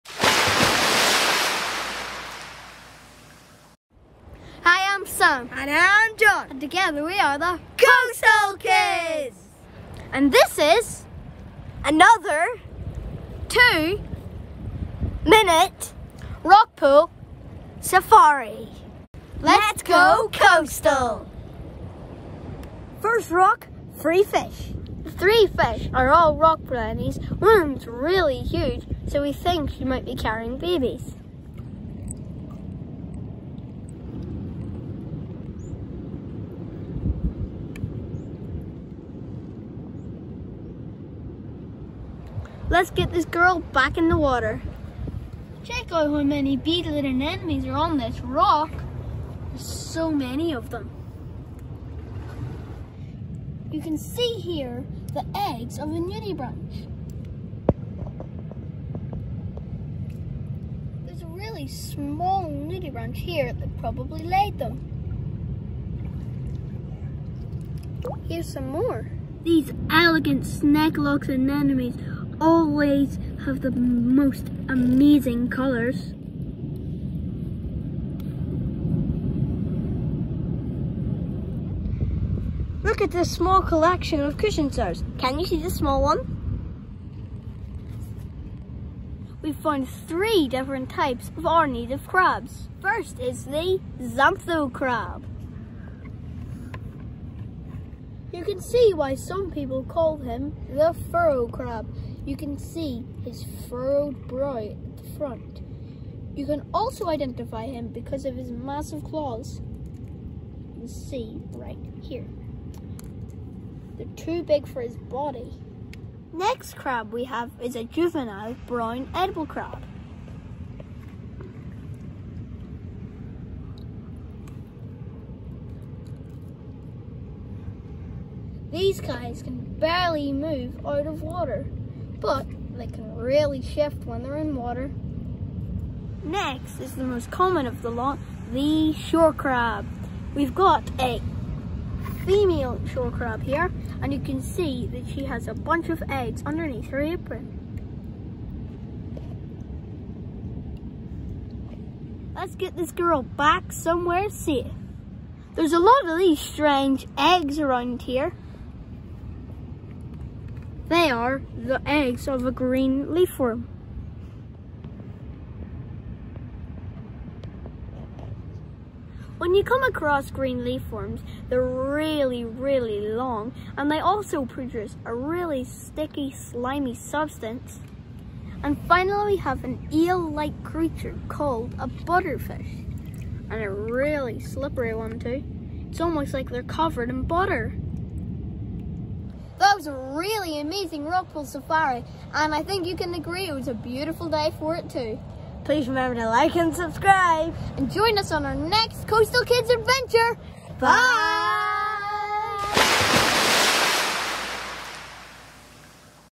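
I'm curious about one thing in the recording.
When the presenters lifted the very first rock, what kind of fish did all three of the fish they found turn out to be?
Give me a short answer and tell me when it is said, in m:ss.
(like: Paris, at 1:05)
rock brownies, at 0:26.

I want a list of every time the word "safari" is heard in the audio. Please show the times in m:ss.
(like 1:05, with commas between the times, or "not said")
0:17, 3:11.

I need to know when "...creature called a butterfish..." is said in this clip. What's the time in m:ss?
3:00.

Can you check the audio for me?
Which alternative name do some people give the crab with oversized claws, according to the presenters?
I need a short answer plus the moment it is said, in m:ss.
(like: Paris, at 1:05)
furrow crab, at 1:41.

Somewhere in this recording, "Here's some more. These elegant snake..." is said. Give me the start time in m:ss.
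1:08.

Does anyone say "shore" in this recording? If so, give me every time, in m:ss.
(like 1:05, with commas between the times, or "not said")
2:18, 2:22.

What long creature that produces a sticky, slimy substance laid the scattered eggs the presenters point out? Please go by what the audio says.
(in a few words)
green leafworm.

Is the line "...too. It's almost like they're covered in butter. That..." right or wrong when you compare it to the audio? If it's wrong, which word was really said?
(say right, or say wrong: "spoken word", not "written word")
right.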